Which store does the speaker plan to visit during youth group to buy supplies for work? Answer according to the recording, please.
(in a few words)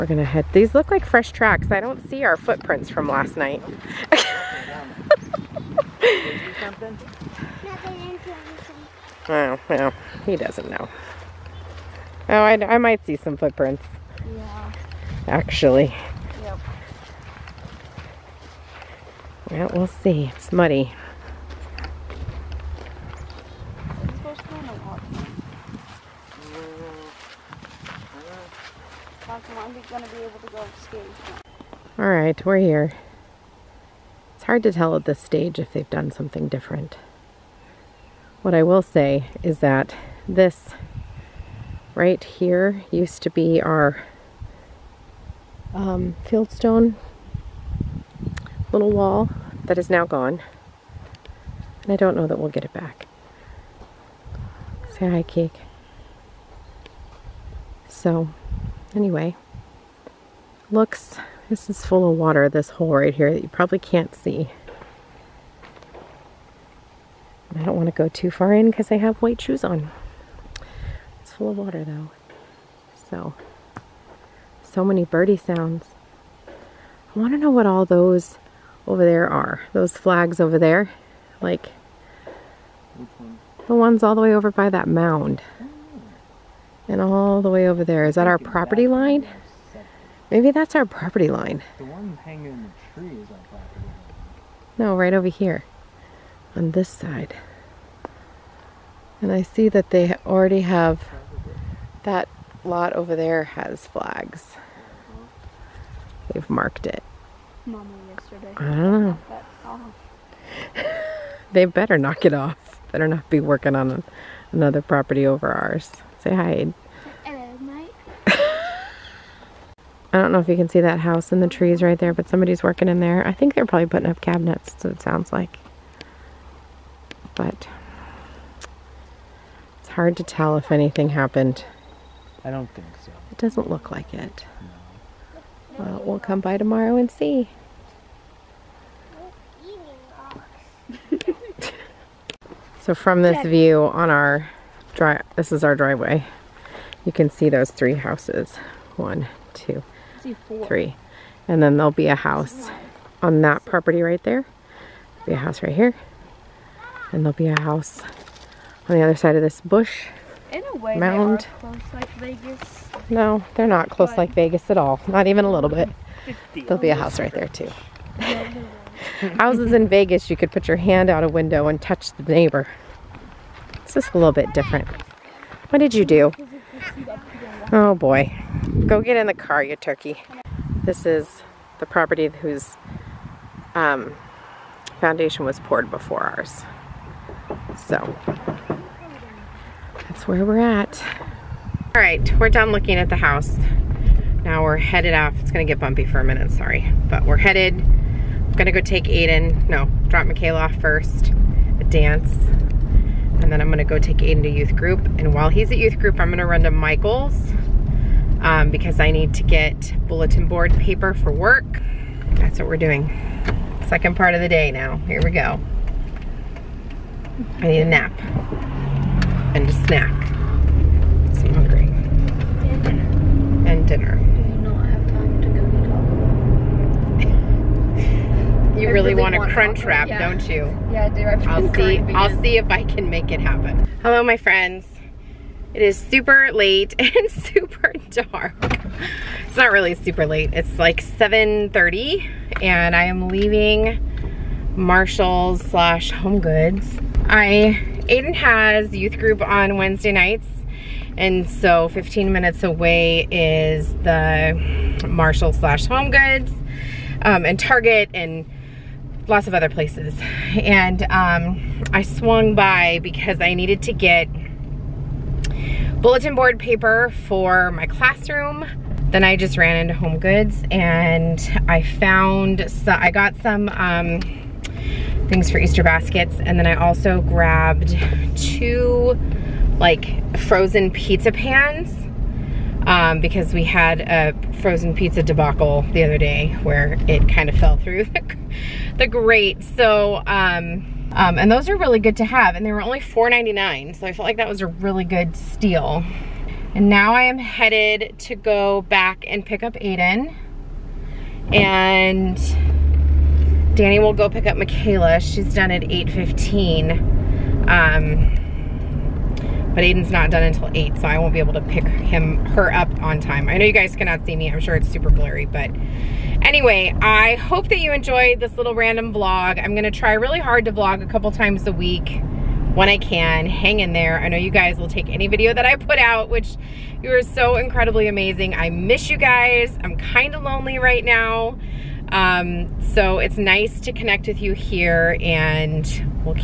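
Michael's.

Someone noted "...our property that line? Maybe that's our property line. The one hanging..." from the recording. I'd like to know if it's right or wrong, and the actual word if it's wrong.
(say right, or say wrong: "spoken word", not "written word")
right.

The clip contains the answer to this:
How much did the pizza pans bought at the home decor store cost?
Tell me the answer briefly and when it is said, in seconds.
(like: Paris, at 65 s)
$4.99, at 292 s.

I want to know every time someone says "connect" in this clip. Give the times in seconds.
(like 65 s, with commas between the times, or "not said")
333 s.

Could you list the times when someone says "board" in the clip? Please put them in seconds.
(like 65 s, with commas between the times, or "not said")
210 s, 266 s.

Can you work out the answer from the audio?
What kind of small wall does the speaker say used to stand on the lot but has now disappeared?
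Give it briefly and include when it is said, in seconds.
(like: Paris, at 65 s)
Fieldstone, at 46 s.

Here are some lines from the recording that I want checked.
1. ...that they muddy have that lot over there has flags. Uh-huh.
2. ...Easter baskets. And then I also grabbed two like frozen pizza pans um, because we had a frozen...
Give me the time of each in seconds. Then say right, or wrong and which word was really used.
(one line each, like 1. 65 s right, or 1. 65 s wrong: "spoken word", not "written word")
1. 99 s wrong: "already", not "muddy"
2. 275 s right.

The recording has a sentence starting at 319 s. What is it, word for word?
I'm gonna try really hard to vlog a couple times a week when I can.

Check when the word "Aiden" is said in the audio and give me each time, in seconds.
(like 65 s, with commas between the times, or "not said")
199 s, 204 s, 248 s, 299 s, 309 s.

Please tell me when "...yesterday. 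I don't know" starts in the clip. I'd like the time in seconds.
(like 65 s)
108 s.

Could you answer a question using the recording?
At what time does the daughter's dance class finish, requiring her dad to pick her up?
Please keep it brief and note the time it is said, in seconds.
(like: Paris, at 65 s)
8:15, at 305 s.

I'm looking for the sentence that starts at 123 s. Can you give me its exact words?
I think they're probably putting up cabinets, so it sounds like.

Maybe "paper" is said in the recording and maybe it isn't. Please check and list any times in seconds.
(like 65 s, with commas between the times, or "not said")
210 s, 266 s.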